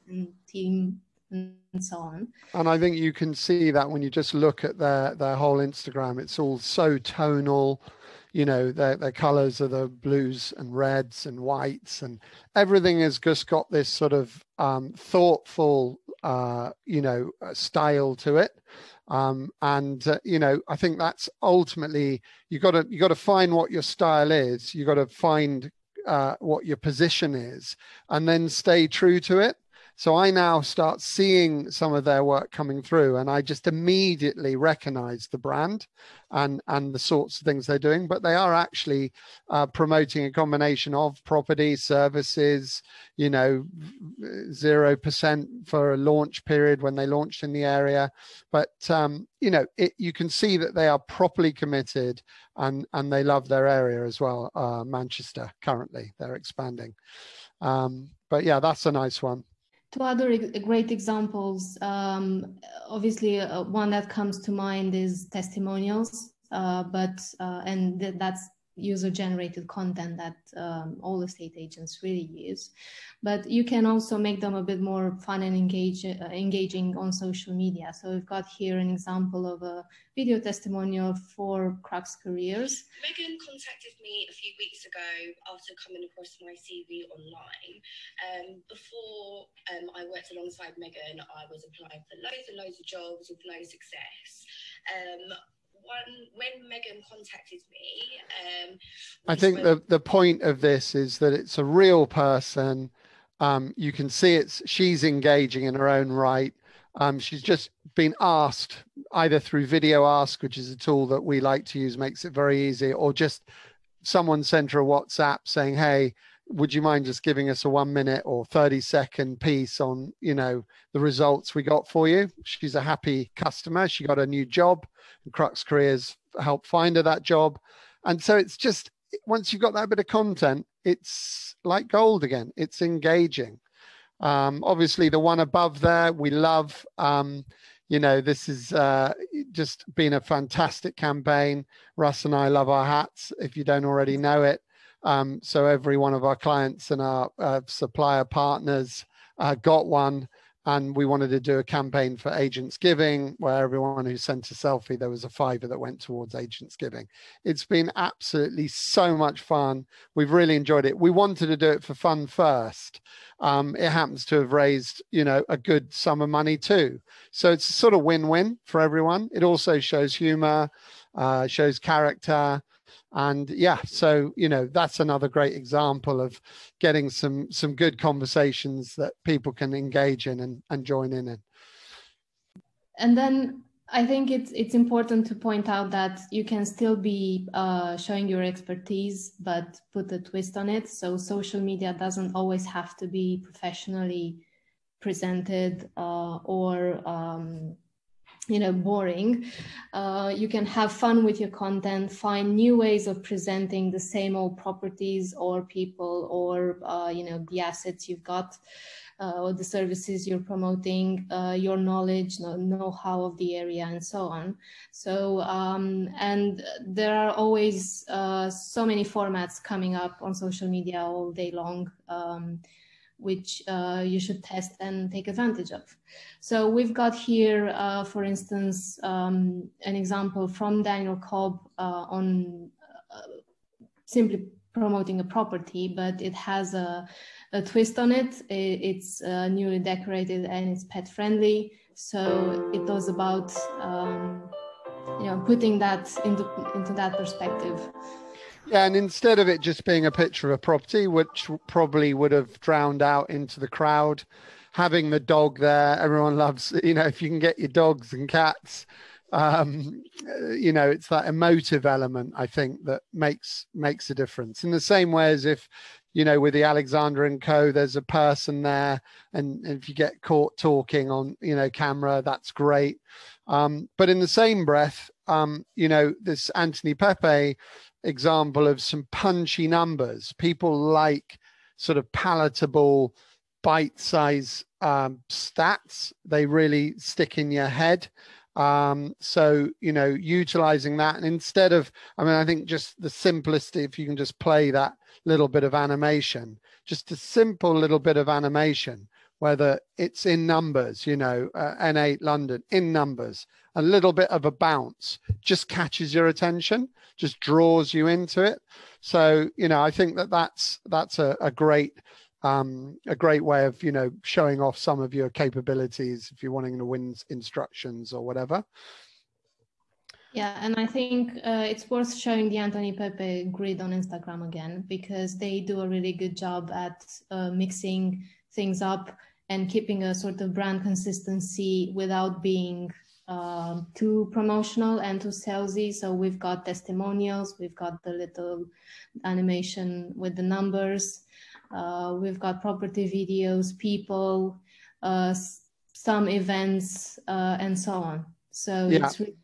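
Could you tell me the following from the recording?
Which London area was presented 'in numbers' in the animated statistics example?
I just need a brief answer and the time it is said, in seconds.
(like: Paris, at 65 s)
N8, at 301 s.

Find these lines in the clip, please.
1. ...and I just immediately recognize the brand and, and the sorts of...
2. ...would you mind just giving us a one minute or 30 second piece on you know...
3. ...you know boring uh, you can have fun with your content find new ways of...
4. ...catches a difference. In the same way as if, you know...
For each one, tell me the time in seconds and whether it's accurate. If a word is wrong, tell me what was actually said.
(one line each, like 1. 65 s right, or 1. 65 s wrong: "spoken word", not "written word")
1. 33 s right
2. 116 s right
3. 198 s right
4. 263 s wrong: "makes", not "catches".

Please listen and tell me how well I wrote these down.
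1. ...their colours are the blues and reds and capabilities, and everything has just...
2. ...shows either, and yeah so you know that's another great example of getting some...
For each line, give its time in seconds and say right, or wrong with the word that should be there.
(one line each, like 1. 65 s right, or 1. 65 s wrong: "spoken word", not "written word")
1. 8 s wrong: "whites", not "capabilities"
2. 171 s wrong: "character", not "either".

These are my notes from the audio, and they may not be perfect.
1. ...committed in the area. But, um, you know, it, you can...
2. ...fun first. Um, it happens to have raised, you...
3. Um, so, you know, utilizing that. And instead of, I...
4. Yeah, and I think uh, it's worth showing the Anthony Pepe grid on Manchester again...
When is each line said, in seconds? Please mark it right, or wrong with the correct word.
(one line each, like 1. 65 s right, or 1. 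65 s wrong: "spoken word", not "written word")
1. 47 s wrong: "launched", not "committed"
2. 161 s right
3. 288 s right
4. 320 s wrong: "Instagram", not "Manchester".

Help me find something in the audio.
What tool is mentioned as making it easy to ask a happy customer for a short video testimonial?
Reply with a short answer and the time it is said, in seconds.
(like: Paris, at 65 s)
VideoAsk, at 109 s.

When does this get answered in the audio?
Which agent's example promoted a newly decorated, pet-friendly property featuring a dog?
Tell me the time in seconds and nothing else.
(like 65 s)
230 s.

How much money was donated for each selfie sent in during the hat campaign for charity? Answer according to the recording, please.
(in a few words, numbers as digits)
£5.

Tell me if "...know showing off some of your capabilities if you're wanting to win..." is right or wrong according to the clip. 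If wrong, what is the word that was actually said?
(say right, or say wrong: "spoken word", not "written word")
right.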